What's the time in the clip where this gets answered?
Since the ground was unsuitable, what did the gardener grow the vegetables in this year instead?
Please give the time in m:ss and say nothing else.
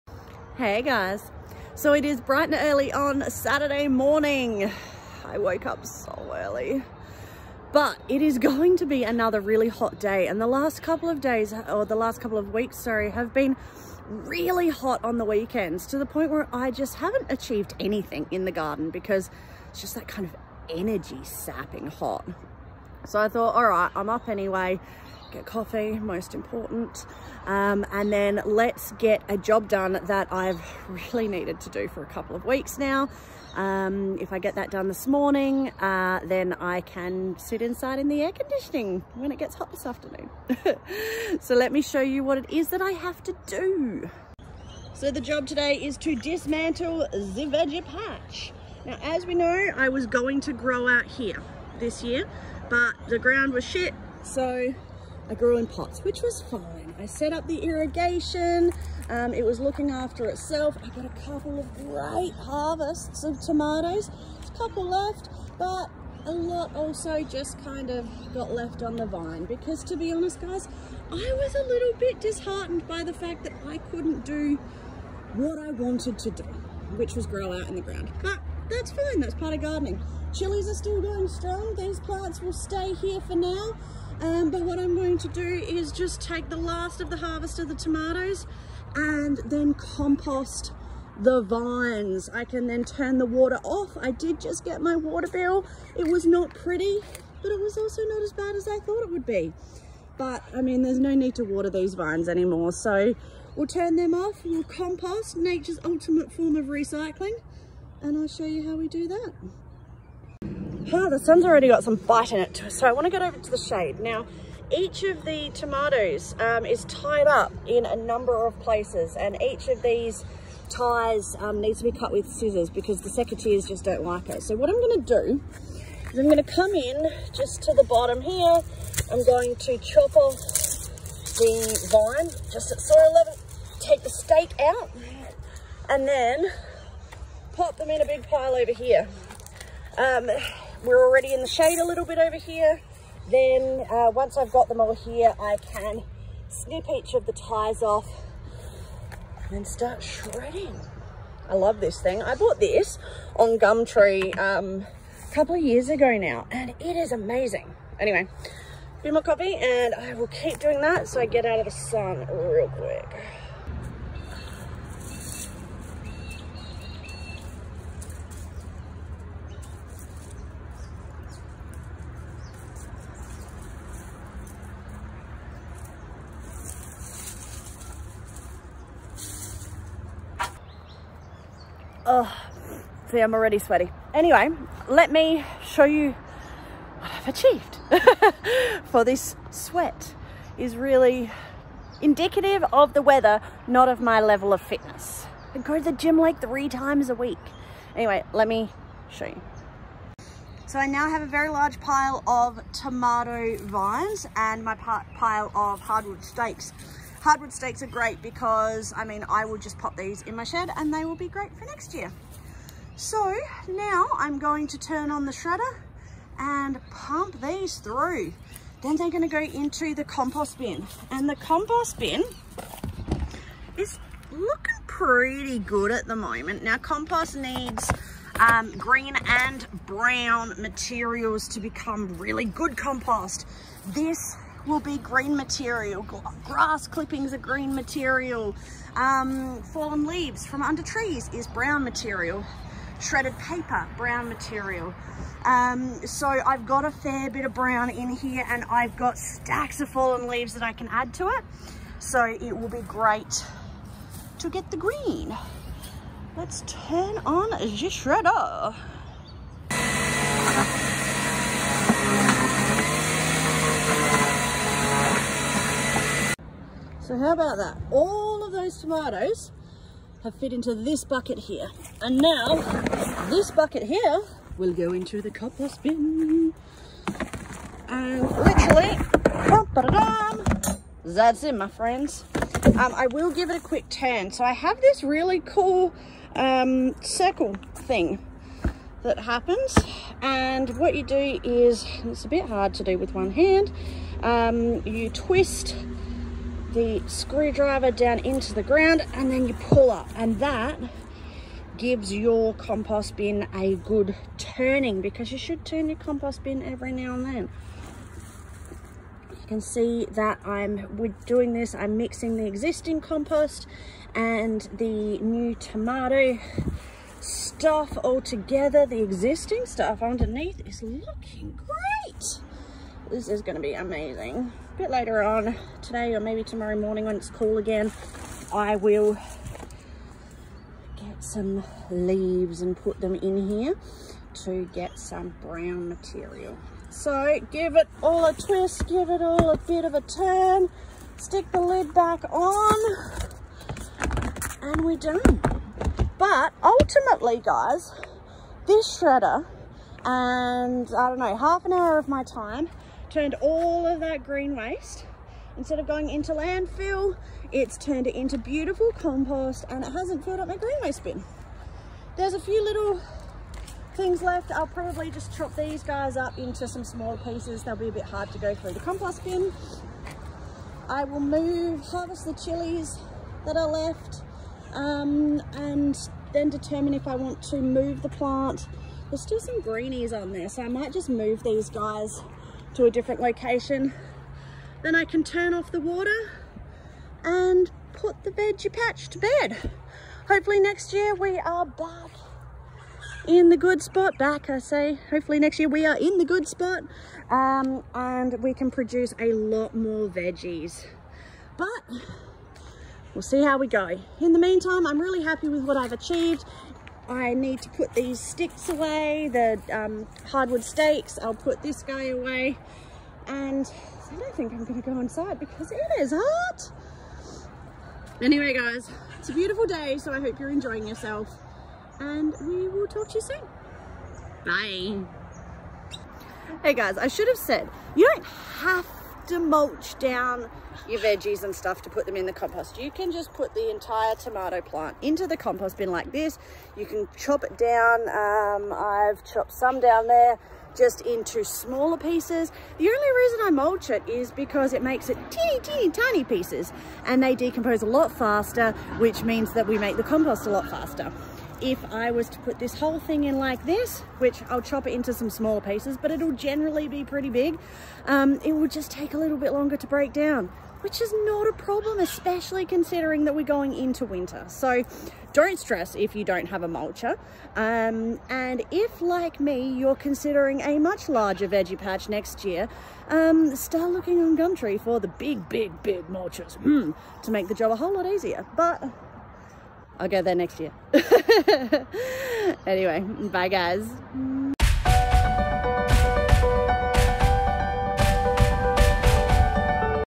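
0:55.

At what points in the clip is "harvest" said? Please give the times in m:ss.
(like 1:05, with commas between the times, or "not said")
1:02, 1:27, 6:11.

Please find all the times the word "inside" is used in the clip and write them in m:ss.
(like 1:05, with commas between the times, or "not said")
0:37, 6:54.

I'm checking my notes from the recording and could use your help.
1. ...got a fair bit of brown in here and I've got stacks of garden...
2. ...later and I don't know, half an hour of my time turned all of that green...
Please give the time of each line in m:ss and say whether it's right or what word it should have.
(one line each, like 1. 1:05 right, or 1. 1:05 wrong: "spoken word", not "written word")
1. 4:06 wrong: "fallen", not "garden"
2. 5:48 wrong: "shredder", not "later".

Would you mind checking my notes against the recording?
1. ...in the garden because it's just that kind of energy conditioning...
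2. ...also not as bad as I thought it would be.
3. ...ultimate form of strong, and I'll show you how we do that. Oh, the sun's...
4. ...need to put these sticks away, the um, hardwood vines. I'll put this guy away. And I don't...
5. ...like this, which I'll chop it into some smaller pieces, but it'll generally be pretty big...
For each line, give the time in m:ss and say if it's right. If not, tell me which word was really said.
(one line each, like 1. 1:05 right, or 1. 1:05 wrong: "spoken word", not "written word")
1. 0:18 wrong: "sapping", not "conditioning"
2. 1:37 right
3. 1:45 wrong: "recycling", not "strong"
4. 6:47 wrong: "stakes", not "vines"
5. 7:33 right.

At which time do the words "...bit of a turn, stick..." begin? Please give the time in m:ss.
5:39.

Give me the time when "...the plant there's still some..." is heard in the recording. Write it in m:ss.
6:18.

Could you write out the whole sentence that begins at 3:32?
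So now I'm going to turn on the shredder and pump these through.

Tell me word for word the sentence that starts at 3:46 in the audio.
Now compost needs um, green and brown materials to become really good compost.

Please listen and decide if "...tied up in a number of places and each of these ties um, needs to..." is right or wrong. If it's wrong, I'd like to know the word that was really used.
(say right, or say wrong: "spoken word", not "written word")
right.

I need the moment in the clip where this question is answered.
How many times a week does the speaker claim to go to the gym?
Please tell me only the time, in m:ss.
3:16.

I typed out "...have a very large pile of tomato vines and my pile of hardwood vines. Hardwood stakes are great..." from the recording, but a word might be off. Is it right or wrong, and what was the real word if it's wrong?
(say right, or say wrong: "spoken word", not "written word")
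wrong: "stakes", not "vines".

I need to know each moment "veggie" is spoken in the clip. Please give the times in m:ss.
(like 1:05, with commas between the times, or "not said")
0:47, 6:28, 6:40, 7:10, 7:51.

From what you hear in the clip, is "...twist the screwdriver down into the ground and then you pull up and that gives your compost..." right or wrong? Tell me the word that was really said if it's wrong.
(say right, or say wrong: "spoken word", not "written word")
right.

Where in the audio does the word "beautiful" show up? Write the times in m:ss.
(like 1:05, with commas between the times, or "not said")
5:58, 6:59.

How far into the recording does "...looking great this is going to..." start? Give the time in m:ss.
5:20.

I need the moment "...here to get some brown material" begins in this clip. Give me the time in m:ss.
5:33.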